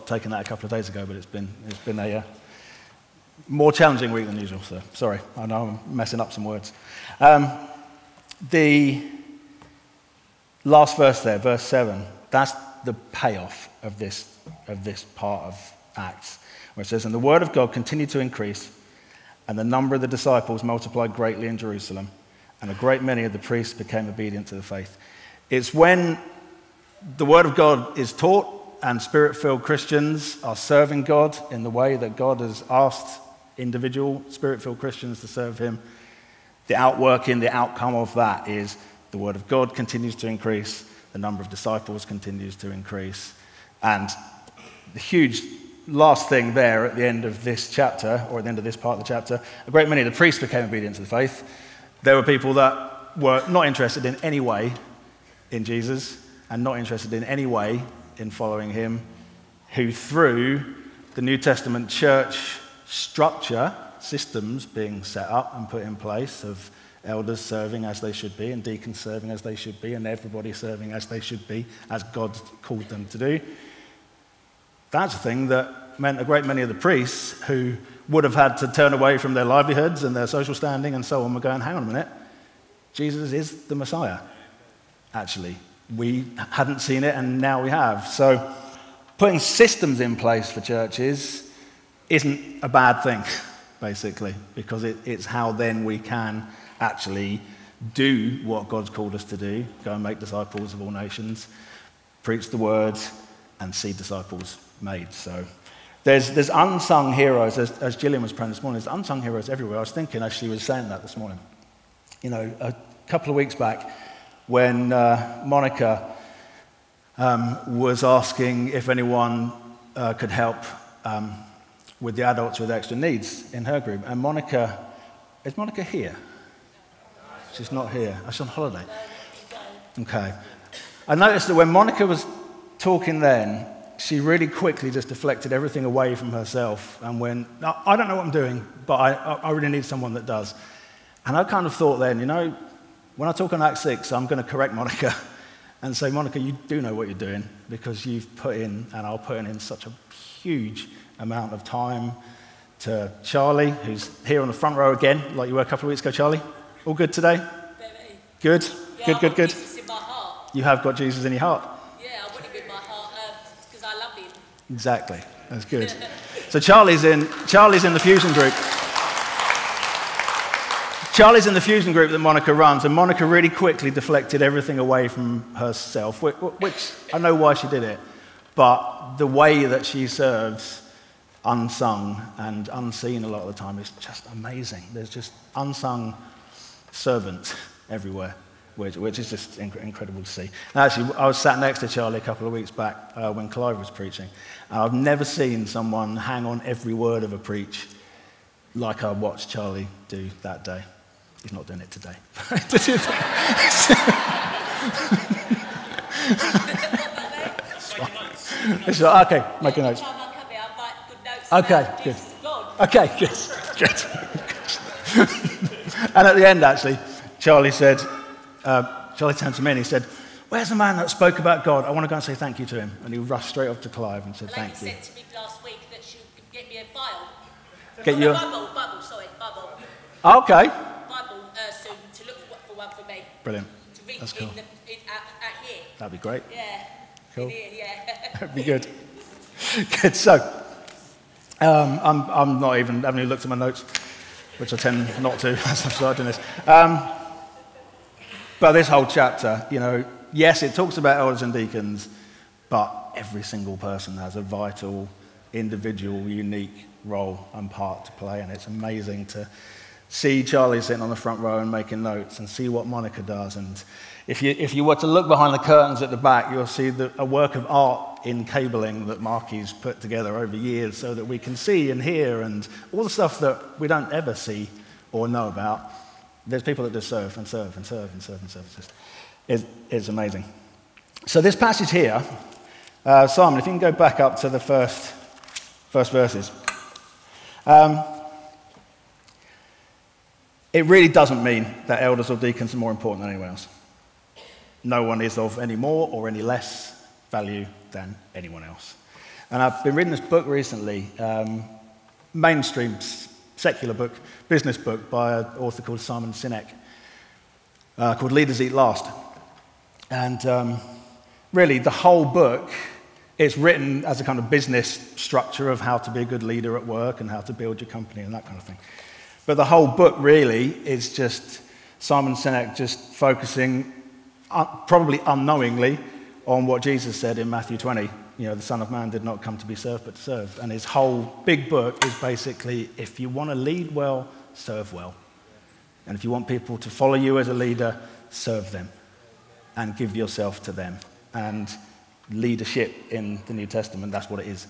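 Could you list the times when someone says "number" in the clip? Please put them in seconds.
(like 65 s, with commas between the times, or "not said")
19 s, 41 s.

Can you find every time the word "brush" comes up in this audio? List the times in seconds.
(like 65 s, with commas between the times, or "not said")
not said.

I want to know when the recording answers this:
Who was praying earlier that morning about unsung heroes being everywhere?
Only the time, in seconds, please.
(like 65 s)
107 s.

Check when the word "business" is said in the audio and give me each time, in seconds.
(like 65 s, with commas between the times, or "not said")
304 s, 314 s.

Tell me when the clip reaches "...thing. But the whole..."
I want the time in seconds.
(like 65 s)
318 s.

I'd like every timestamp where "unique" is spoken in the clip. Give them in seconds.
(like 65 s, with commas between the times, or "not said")
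256 s.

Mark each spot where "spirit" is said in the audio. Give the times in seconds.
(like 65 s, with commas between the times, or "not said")
29 s, 34 s.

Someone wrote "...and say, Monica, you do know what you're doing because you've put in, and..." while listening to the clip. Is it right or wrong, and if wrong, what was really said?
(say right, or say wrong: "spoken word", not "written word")
right.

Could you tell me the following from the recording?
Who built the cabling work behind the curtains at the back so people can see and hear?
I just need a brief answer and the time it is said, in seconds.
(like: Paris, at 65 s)
Marky, at 269 s.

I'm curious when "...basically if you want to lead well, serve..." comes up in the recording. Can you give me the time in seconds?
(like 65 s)
332 s.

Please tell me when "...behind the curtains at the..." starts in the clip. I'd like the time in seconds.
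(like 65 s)
265 s.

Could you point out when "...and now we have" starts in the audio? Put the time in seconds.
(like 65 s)
87 s.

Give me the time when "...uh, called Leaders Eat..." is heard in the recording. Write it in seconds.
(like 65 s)
307 s.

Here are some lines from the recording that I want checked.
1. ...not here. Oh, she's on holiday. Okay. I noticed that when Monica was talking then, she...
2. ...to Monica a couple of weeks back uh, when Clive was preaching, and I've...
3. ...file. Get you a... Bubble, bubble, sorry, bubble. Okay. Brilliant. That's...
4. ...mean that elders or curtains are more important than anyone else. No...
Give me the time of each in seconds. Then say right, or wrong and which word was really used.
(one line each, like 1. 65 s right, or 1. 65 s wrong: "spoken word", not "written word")
1. 127 s right
2. 191 s wrong: "Charlie", not "Monica"
3. 226 s right
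4. 291 s wrong: "deacons", not "curtains".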